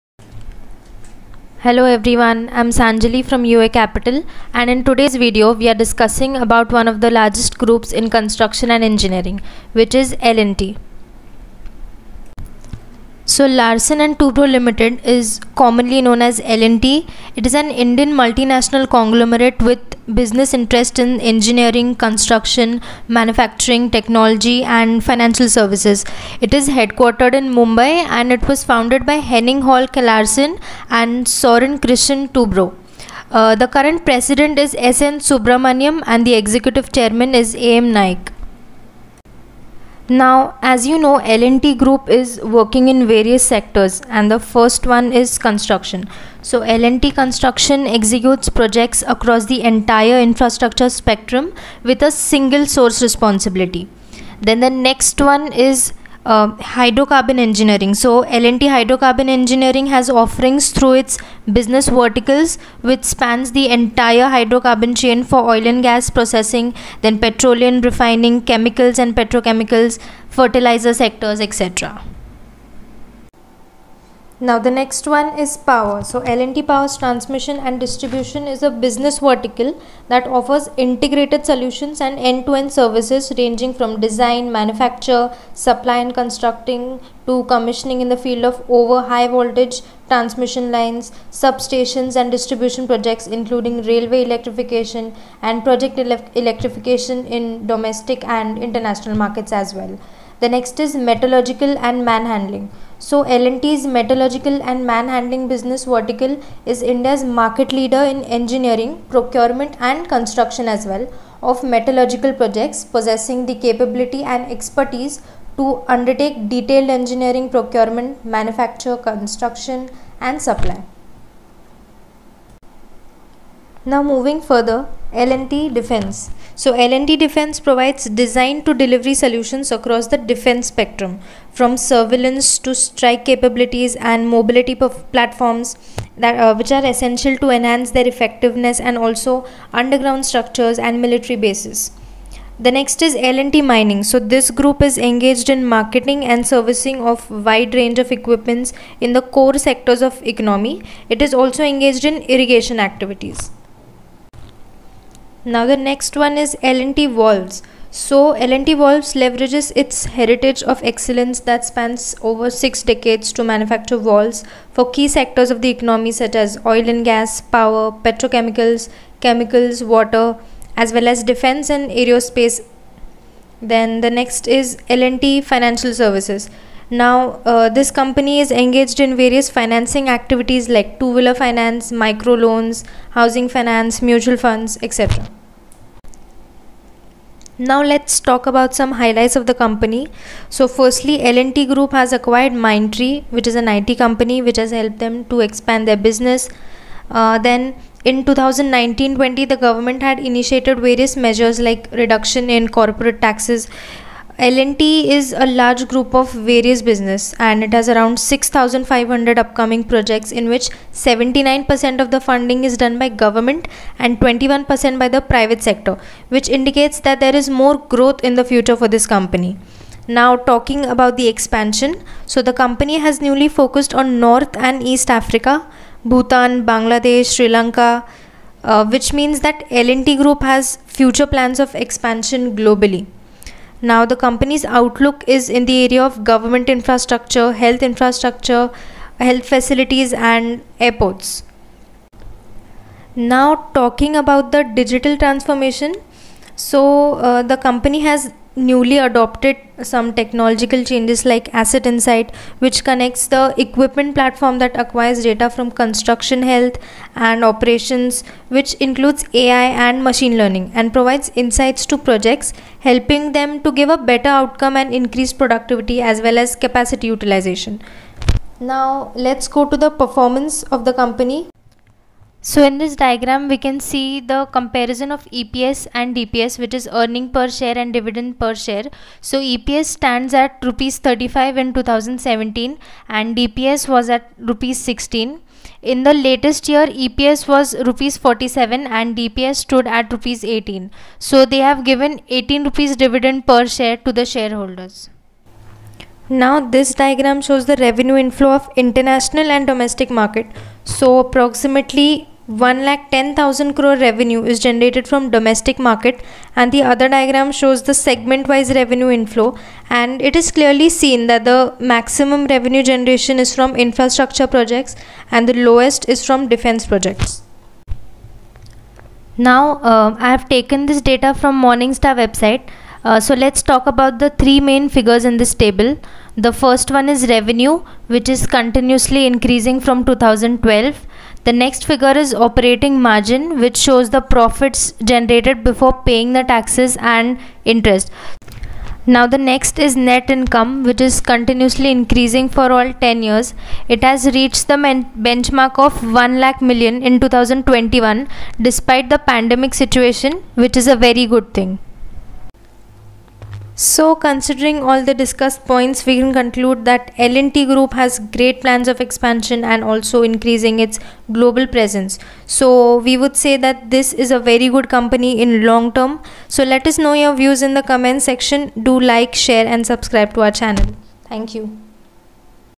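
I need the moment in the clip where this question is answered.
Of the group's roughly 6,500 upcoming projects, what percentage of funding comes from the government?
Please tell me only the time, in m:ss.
3:31.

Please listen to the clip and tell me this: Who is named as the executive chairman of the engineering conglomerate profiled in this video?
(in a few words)
A.M. Naik.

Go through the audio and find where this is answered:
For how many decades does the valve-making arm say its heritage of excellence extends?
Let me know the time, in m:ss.
2:42.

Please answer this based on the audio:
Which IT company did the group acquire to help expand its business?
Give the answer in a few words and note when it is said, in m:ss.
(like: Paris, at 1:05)
Mindtree, at 3:12.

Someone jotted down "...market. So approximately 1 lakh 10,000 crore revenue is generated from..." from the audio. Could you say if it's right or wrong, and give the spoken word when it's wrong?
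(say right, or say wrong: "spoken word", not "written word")
right.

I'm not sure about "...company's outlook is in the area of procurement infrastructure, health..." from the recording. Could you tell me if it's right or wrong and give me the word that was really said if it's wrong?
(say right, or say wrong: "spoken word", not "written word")
wrong: "government", not "procurement".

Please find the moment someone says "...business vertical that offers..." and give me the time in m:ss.
1:18.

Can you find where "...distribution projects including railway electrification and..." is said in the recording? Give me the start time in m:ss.
1:32.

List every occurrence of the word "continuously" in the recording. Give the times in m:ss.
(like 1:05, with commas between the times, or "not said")
5:28, 5:41.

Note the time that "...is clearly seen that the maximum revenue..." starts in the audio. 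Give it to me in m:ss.
5:10.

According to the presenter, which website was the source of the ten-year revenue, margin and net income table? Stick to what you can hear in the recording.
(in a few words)
Morningstar.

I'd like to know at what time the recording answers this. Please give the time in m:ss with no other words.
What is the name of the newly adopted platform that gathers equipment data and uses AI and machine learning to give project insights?
4:11.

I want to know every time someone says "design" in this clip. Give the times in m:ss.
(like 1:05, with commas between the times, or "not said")
1:24, 2:08.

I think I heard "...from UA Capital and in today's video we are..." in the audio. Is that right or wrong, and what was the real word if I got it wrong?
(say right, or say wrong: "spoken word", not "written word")
right.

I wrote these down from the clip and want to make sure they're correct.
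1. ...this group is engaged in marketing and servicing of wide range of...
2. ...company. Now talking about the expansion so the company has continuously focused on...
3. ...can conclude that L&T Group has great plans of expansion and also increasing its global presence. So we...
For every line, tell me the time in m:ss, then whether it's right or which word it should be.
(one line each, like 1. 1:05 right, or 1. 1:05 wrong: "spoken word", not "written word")
1. 2:24 right
2. 3:39 wrong: "newly", not "continuously"
3. 5:56 right.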